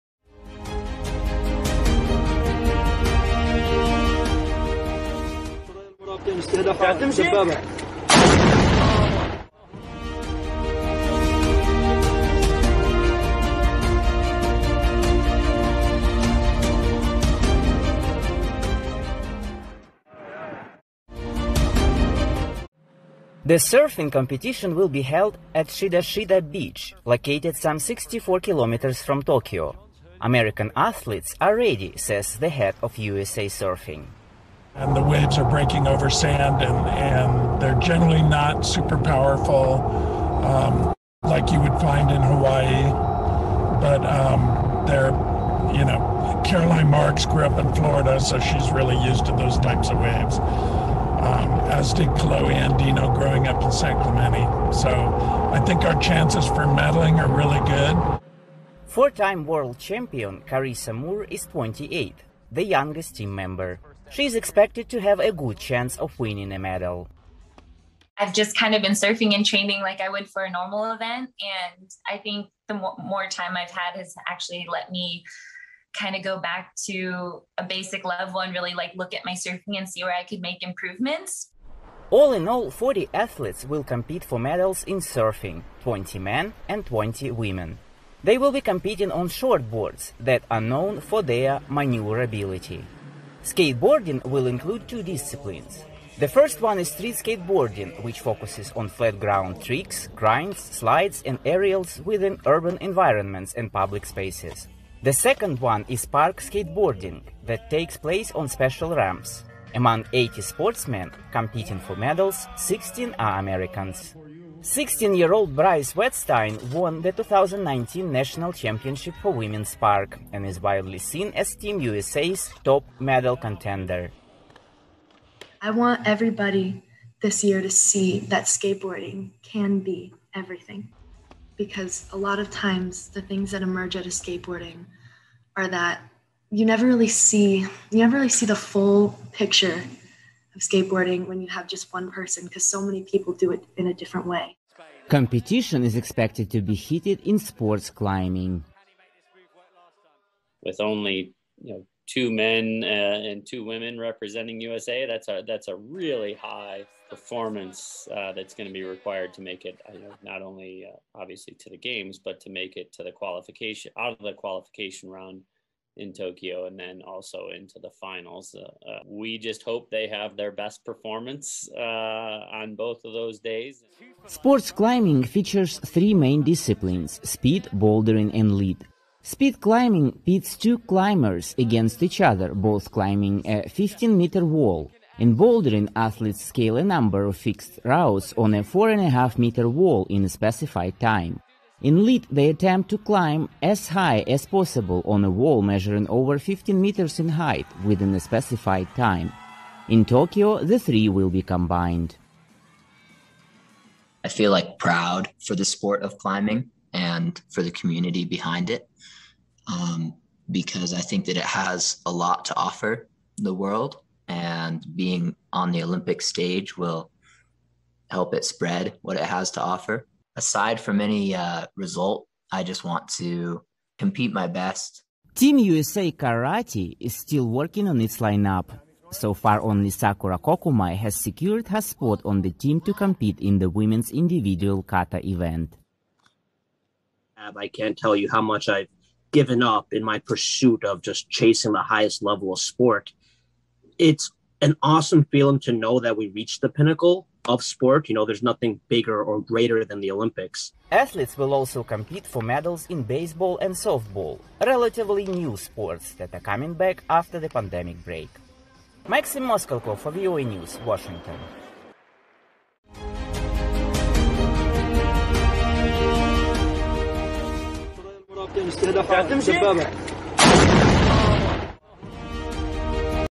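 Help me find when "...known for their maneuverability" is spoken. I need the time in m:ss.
1:30.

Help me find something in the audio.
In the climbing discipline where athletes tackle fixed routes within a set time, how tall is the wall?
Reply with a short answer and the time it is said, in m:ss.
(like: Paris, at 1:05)
4.5 meters, at 3:08.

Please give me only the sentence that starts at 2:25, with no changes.
Competition is expected to be heated in sports climbing.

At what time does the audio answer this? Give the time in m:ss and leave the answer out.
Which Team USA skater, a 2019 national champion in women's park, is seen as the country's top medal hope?
1:55.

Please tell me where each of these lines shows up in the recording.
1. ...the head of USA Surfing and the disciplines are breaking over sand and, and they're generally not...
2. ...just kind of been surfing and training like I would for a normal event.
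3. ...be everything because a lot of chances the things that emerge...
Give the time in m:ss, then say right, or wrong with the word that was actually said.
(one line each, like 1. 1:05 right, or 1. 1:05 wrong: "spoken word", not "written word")
1. 0:32 wrong: "waves", not "disciplines"
2. 1:08 right
3. 2:09 wrong: "times", not "chances".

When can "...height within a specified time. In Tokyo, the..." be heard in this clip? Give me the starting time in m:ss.
3:17.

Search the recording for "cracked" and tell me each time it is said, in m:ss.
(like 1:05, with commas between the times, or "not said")
not said.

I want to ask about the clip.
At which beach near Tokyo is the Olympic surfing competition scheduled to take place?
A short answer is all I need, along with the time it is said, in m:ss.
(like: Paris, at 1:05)
Shidashita Beach, at 0:25.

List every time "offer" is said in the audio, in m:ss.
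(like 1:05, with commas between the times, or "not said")
3:32, 3:39.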